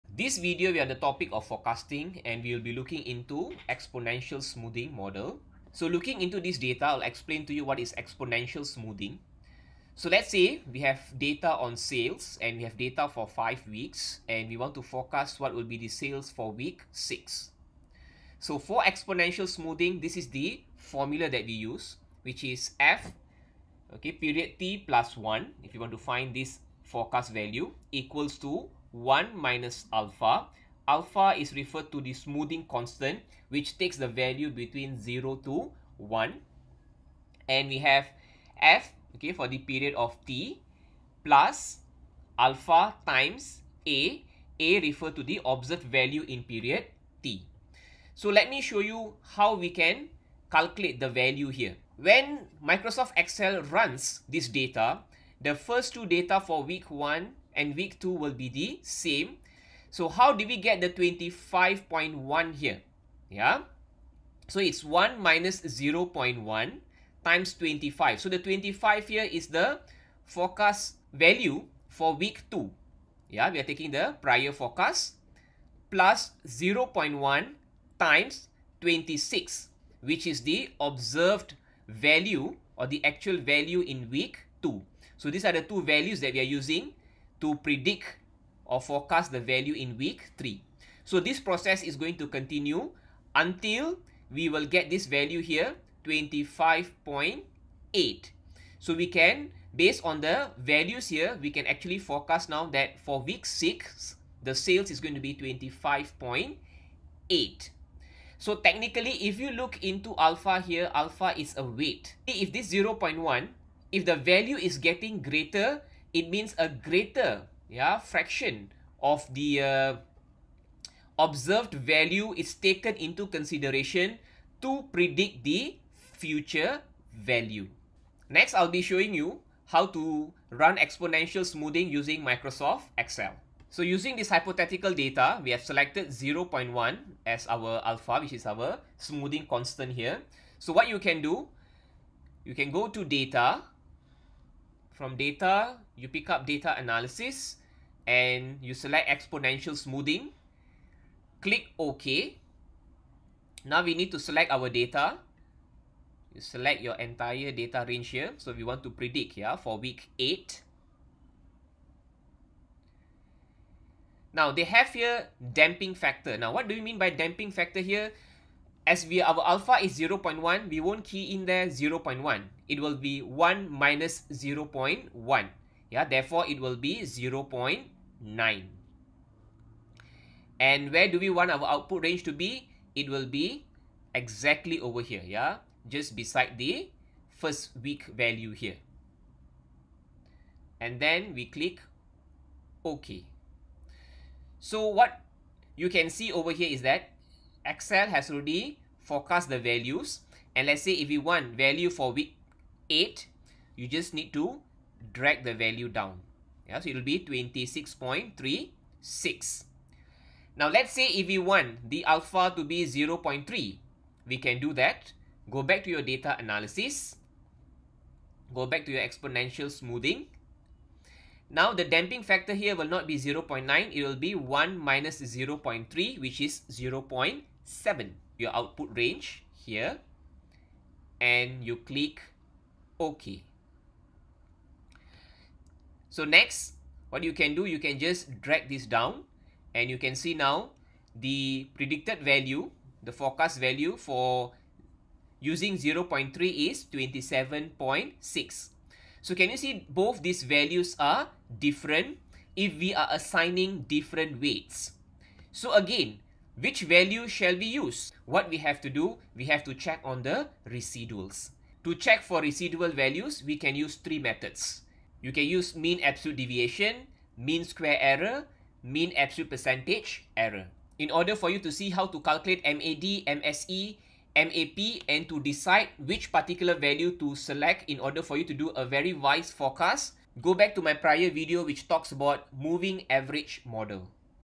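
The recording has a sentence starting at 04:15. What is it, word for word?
So again, which value shall we use?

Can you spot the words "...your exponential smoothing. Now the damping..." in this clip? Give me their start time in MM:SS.
03:38.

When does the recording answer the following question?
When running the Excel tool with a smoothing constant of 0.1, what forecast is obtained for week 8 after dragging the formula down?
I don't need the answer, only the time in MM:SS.
03:27.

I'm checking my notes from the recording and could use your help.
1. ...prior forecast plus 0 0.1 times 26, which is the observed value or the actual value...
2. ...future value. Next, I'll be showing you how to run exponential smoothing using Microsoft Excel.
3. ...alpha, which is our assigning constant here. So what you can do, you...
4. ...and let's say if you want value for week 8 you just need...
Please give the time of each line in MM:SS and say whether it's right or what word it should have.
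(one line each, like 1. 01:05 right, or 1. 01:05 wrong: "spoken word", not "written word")
1. 01:14 right
2. 02:05 right
3. 02:17 wrong: "smoothing", not "assigning"
4. 03:20 right.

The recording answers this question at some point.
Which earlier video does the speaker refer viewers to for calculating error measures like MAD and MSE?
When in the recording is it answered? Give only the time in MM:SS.
04:42.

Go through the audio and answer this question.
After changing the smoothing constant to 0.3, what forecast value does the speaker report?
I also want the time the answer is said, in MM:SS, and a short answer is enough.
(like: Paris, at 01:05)
27.6, at 04:06.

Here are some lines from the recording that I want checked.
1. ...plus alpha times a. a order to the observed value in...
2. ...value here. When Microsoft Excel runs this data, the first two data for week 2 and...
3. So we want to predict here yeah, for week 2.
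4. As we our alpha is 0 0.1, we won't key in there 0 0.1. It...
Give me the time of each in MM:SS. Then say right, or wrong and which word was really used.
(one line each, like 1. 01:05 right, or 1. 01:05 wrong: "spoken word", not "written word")
1. 00:41 wrong: "refer", not "order"
2. 00:51 wrong: "1", not "2"
3. 02:38 wrong: "8", not "2"
4. 02:48 right.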